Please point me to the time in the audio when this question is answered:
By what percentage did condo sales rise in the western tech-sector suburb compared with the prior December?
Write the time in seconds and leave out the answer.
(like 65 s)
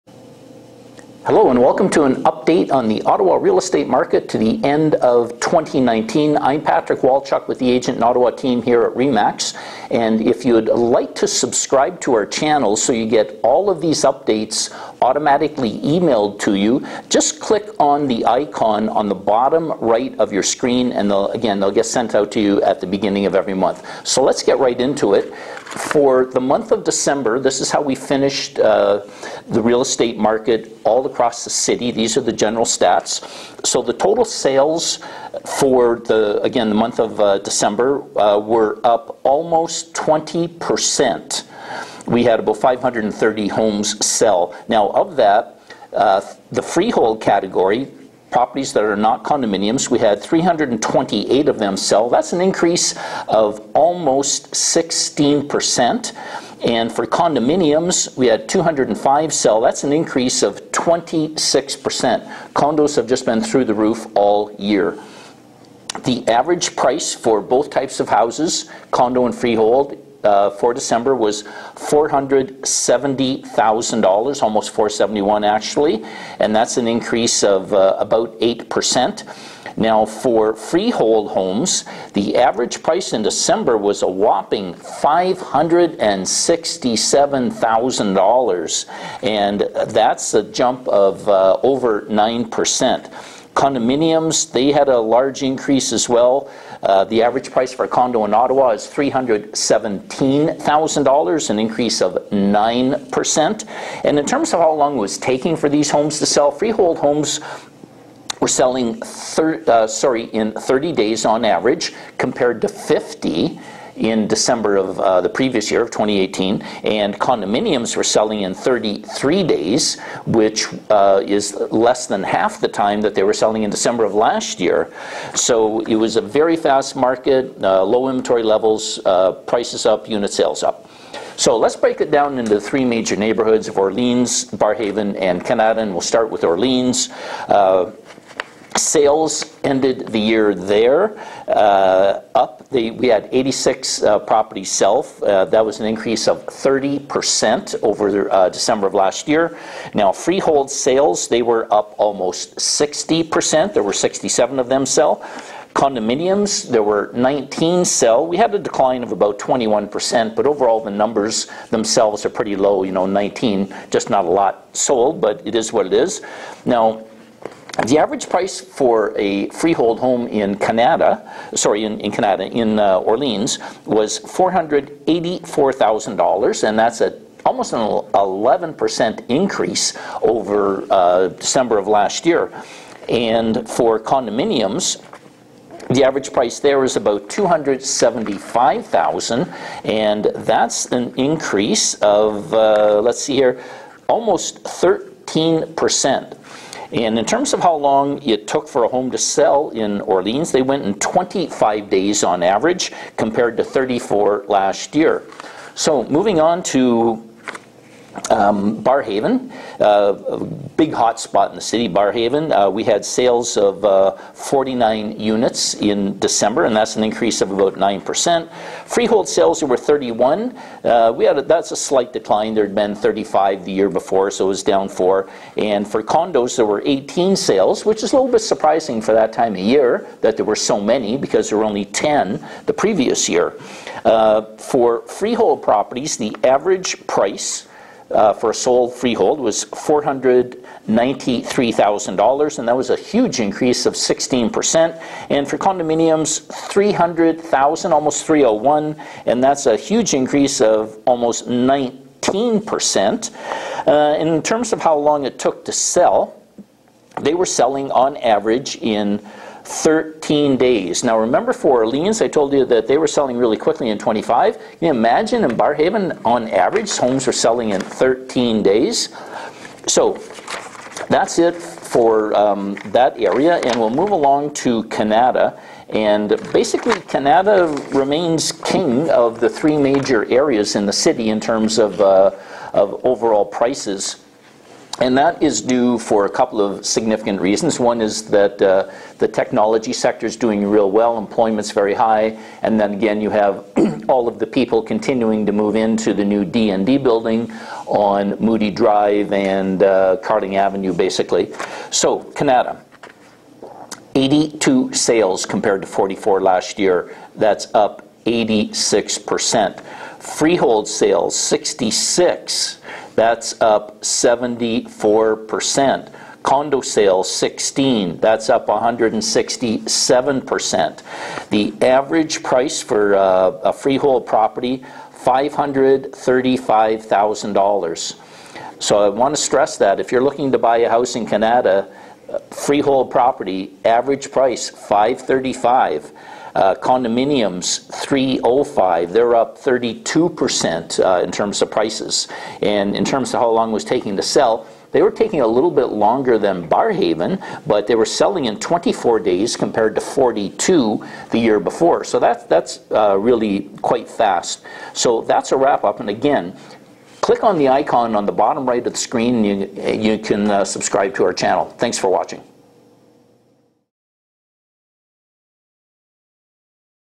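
318 s.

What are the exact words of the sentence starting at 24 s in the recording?
So let's get right into it.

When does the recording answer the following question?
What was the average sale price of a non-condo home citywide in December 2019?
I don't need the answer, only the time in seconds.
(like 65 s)
84 s.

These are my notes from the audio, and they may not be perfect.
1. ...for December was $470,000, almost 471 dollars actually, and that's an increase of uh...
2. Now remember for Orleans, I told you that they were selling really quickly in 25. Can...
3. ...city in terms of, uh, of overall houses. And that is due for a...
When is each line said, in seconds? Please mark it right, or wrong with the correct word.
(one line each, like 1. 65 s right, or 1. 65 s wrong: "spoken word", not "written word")
1. 70 s right
2. 261 s right
3. 280 s wrong: "prices", not "houses".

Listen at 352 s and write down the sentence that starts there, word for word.
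So that, that's uh, really quite fast.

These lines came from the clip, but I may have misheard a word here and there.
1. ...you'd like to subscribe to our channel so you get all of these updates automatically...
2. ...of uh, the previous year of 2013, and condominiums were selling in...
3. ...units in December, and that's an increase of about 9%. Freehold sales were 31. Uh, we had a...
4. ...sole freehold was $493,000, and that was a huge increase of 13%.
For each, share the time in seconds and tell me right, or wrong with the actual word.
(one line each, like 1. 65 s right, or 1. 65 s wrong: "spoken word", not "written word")
1. 10 s right
2. 114 s wrong: "2018", not "2013"
3. 215 s right
4. 238 s wrong: "16", not "13".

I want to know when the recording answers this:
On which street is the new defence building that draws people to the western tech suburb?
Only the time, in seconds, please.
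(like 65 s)
298 s.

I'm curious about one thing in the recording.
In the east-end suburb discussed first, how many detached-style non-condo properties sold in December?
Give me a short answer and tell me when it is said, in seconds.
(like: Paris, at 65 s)
67, at 153 s.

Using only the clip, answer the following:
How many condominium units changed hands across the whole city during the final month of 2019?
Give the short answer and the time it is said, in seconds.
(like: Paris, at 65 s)
205, at 58 s.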